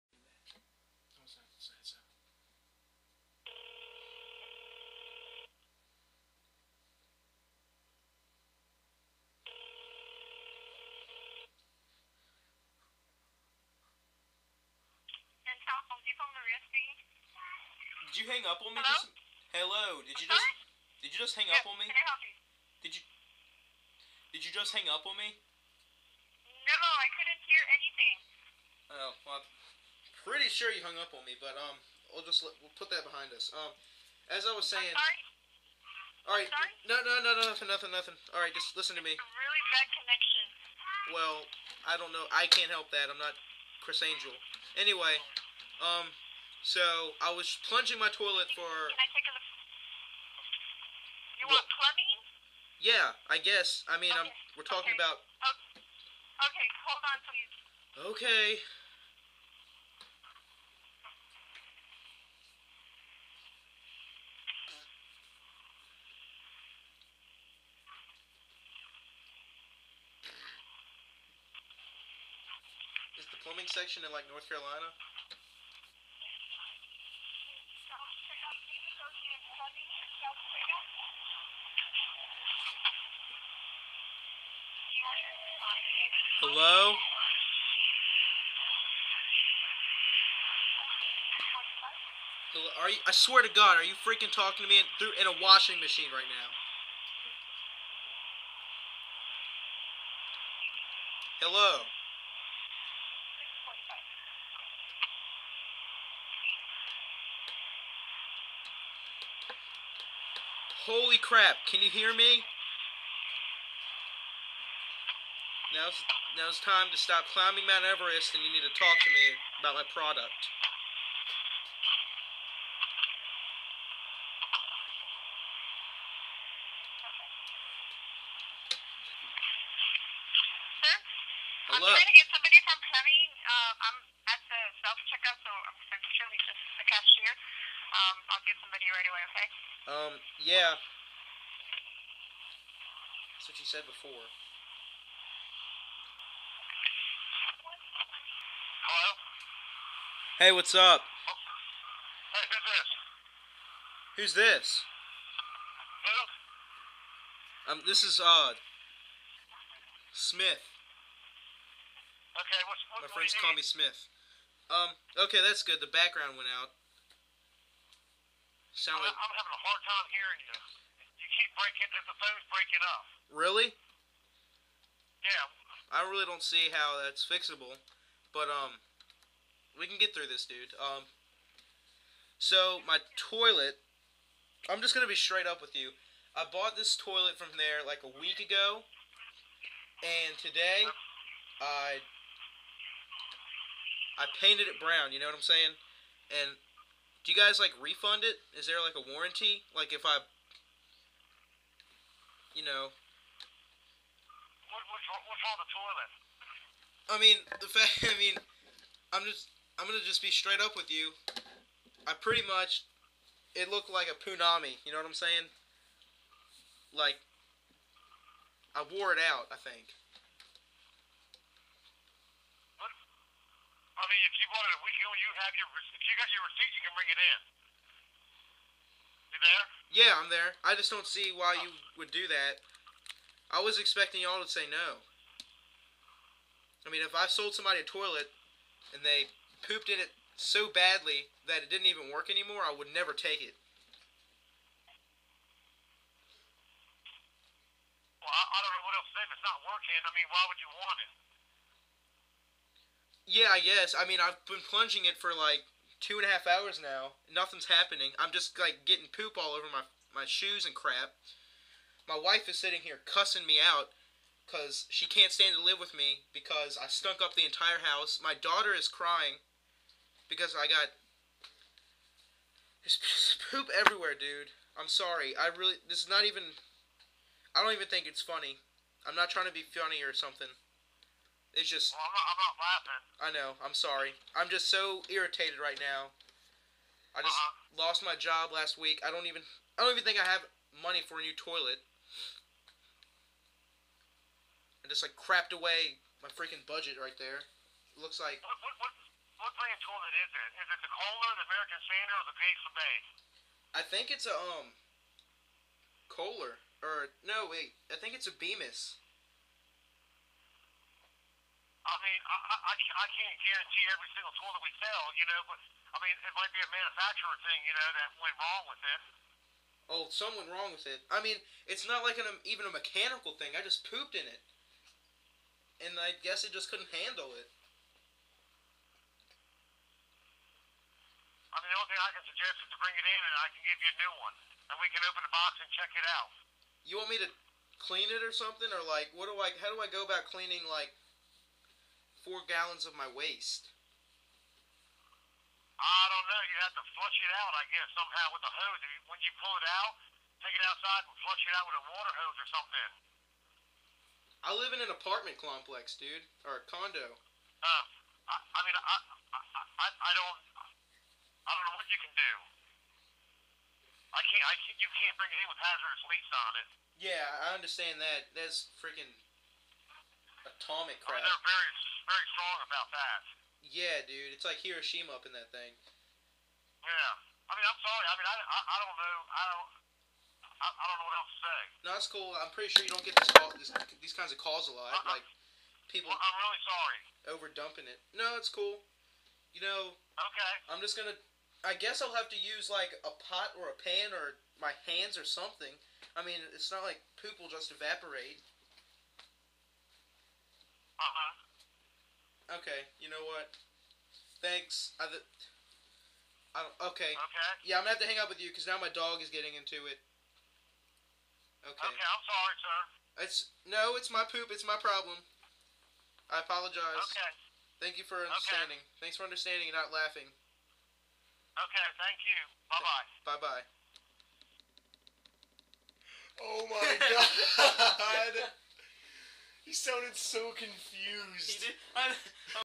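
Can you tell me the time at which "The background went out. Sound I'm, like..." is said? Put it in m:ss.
2:45.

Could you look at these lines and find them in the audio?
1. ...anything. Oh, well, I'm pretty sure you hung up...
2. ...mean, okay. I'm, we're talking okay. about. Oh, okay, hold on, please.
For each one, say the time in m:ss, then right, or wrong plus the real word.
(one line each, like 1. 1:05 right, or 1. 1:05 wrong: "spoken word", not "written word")
1. 0:27 right
2. 0:53 right.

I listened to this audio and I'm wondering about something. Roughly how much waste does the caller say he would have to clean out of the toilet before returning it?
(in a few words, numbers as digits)
4 gallons.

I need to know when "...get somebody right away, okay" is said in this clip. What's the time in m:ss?
2:18.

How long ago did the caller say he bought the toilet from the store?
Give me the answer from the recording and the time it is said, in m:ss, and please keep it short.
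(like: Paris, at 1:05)
a week ago, at 3:07.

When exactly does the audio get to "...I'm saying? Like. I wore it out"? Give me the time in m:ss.
3:35.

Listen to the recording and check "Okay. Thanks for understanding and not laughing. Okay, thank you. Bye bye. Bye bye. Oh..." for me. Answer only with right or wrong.
right.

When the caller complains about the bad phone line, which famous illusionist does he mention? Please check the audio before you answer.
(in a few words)
Criss Angel.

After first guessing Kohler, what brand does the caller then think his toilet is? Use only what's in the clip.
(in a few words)
Bemis.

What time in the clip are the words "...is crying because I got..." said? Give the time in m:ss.
4:28.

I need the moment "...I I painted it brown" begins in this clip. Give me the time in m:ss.
3:11.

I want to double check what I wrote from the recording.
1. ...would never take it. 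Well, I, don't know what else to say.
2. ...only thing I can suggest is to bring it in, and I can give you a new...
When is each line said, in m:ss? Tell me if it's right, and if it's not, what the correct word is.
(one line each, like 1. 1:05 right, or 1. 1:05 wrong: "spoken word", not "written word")
1. 4:02 right
2. 5:31 right.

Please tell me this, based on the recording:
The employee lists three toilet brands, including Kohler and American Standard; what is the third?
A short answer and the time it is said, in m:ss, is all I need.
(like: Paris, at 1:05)
Glacier Bay, at 5:02.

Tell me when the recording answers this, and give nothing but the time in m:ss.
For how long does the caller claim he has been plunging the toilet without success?
4:16.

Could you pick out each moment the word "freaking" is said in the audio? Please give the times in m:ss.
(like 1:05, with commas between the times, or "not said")
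1:33, 4:56, 6:08.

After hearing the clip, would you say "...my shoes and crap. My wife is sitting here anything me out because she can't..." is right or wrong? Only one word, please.
wrong.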